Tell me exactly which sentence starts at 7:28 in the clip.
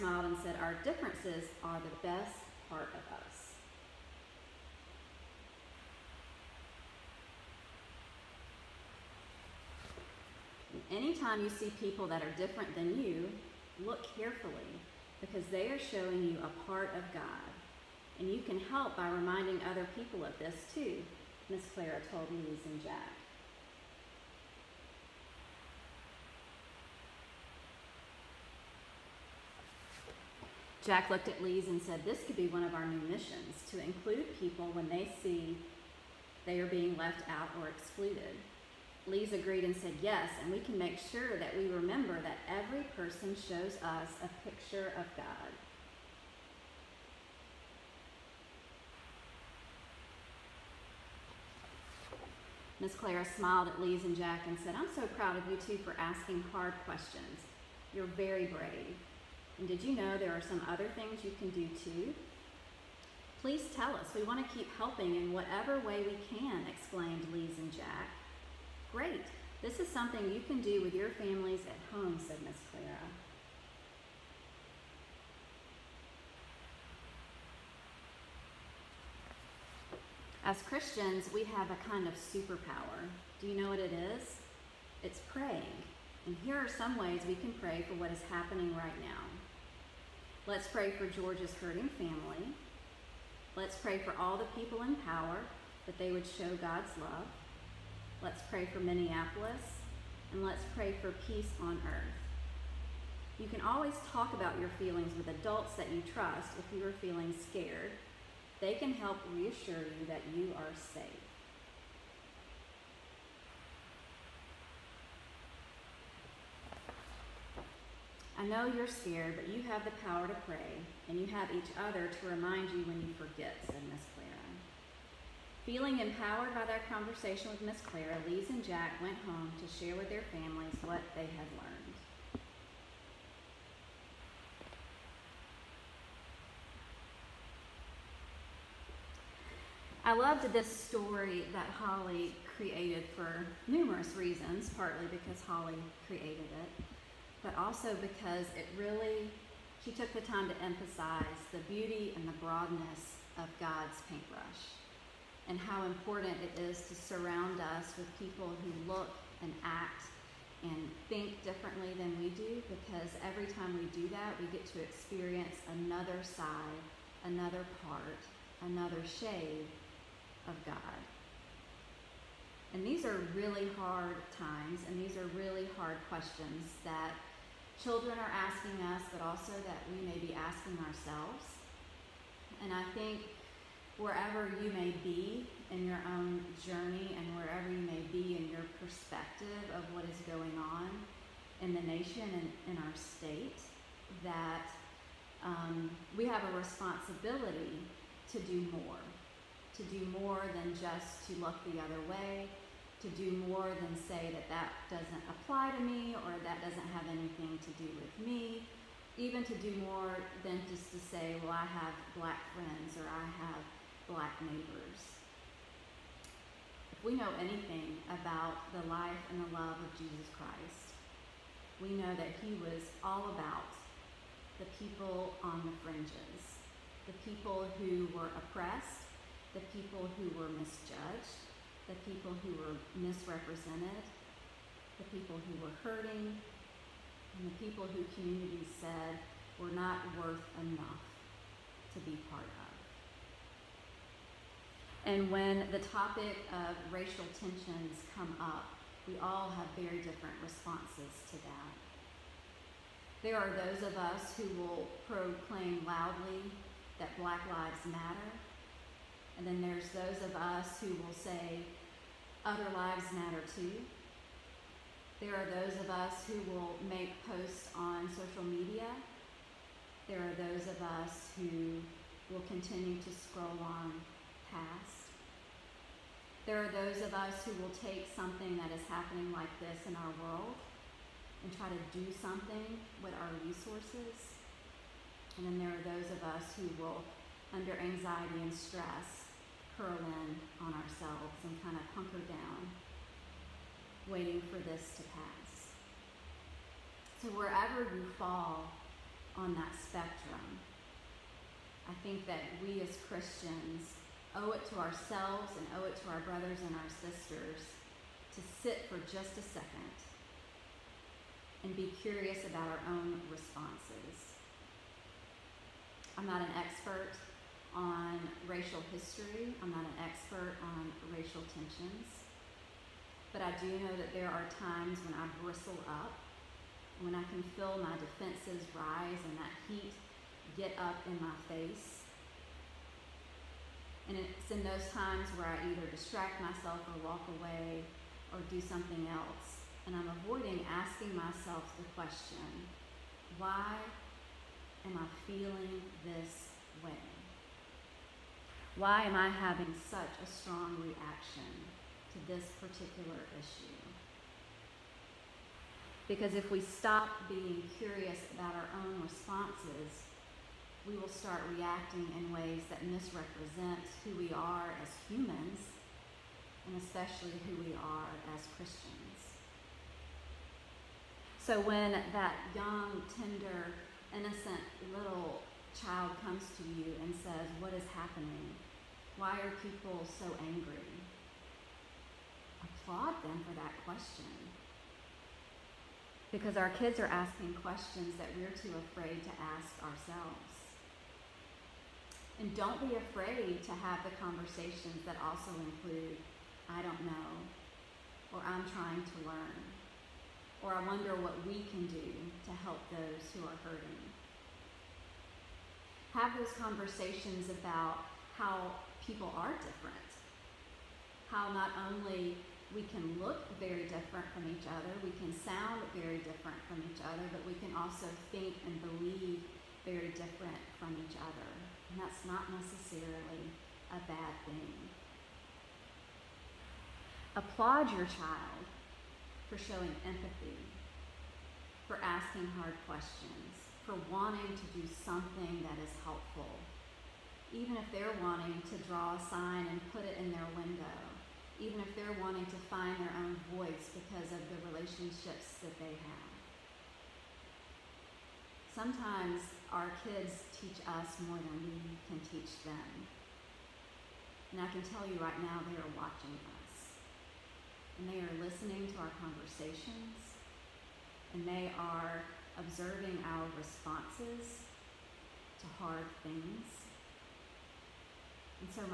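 Sometimes our kids teach us more than we can teach them.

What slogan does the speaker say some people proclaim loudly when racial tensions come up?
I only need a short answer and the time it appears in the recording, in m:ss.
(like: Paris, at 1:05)
Black Lives Matter, at 4:17.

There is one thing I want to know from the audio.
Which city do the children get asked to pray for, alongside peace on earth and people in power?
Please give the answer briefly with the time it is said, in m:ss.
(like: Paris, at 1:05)
Minneapolis, at 1:38.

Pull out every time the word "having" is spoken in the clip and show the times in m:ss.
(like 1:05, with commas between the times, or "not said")
5:49.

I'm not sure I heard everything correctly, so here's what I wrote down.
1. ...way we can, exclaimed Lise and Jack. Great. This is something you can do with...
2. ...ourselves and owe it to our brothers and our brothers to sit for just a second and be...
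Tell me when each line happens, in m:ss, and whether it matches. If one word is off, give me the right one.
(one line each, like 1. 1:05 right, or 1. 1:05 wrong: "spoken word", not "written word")
1. 1:05 right
2. 5:04 wrong: "sisters", not "brothers".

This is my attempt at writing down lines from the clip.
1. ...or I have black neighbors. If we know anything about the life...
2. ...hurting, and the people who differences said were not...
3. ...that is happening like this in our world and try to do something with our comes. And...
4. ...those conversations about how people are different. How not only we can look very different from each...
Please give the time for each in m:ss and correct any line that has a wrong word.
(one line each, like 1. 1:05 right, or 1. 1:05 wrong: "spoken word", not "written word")
1. 3:32 right
2. 3:55 wrong: "communities", not "differences"
3. 4:38 wrong: "resources", not "comes"
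4. 6:46 right.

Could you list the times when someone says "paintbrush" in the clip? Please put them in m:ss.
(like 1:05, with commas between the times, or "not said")
2:34.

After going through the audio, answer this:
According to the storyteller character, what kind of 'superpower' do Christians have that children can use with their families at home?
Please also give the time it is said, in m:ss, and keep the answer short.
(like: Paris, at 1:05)
Praying, at 1:25.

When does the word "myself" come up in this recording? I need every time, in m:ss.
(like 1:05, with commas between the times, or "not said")
5:36, 5:41.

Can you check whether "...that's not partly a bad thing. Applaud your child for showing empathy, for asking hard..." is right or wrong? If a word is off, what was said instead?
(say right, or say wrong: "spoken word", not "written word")
wrong: "necessarily", not "partly".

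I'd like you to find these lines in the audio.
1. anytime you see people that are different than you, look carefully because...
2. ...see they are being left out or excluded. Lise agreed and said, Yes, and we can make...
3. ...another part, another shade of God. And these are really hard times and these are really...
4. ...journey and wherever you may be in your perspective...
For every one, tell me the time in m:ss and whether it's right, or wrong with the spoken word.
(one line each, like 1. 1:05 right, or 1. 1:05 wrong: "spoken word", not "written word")
1. 0:10 right
2. 0:35 right
3. 2:47 right
4. 3:06 right.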